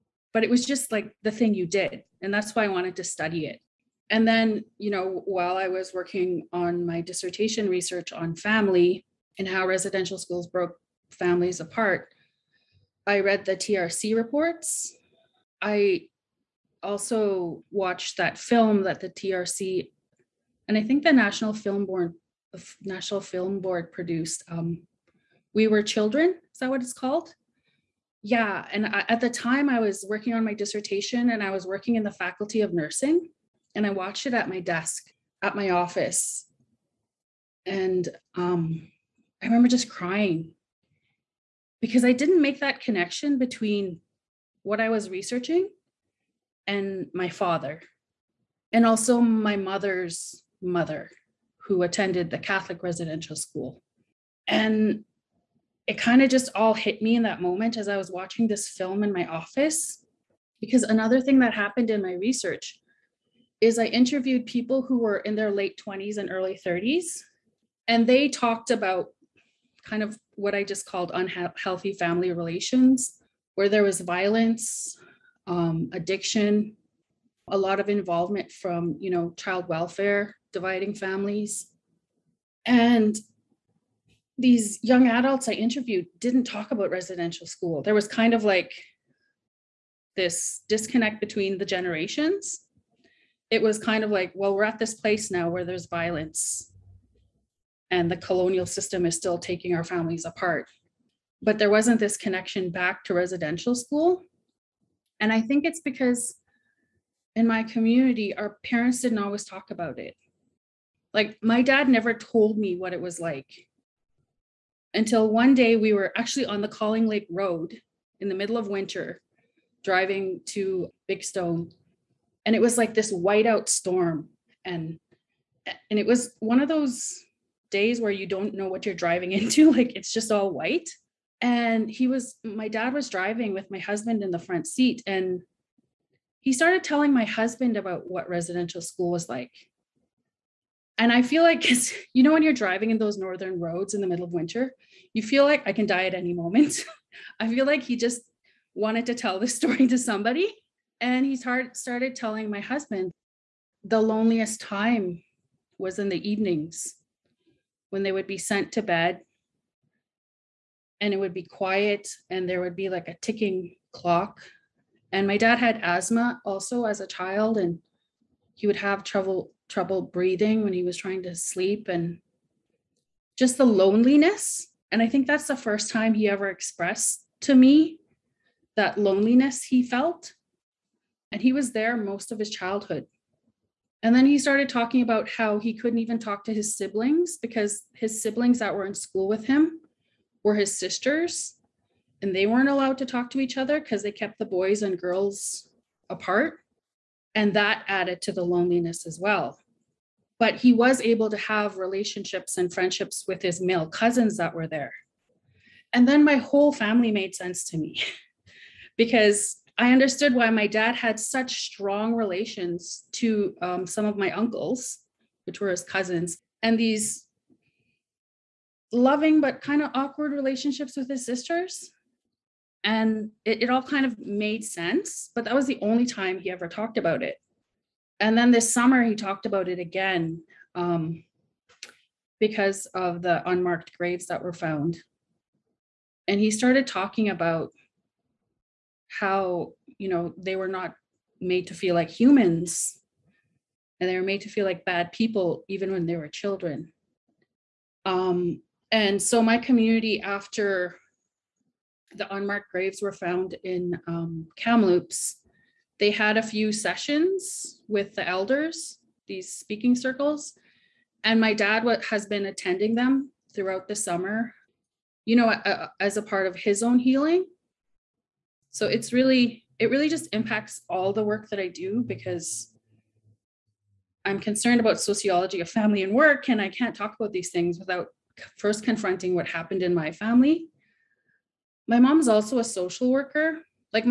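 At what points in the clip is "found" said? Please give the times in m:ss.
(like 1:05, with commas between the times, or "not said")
3:54, 4:13.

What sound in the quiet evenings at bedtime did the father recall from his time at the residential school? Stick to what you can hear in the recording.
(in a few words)
A ticking clock.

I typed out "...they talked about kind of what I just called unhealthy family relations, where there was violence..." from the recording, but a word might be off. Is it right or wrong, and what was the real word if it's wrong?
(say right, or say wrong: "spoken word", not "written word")
right.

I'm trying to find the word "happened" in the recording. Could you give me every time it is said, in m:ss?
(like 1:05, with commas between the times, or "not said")
1:01, 4:39.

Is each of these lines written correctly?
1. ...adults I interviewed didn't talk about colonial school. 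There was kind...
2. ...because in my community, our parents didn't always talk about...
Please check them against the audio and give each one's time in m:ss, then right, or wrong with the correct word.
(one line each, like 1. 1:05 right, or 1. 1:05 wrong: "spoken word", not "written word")
1. 1:25 wrong: "residential", not "colonial"
2. 1:45 right.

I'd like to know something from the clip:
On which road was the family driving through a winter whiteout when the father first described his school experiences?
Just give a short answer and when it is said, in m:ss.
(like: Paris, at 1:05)
Calling Lake Road, at 1:56.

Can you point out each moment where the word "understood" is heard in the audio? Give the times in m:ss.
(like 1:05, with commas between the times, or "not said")
3:29.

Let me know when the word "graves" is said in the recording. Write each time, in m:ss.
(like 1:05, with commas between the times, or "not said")
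3:53, 4:12.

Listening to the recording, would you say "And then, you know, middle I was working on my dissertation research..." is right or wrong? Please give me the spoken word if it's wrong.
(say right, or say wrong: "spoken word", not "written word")
wrong: "while", not "middle".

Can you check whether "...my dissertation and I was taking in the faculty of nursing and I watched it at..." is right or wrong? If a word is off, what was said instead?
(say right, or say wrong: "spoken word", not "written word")
wrong: "working", not "taking".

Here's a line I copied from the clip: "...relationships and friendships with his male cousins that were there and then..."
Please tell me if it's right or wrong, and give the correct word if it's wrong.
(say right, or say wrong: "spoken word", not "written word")
right.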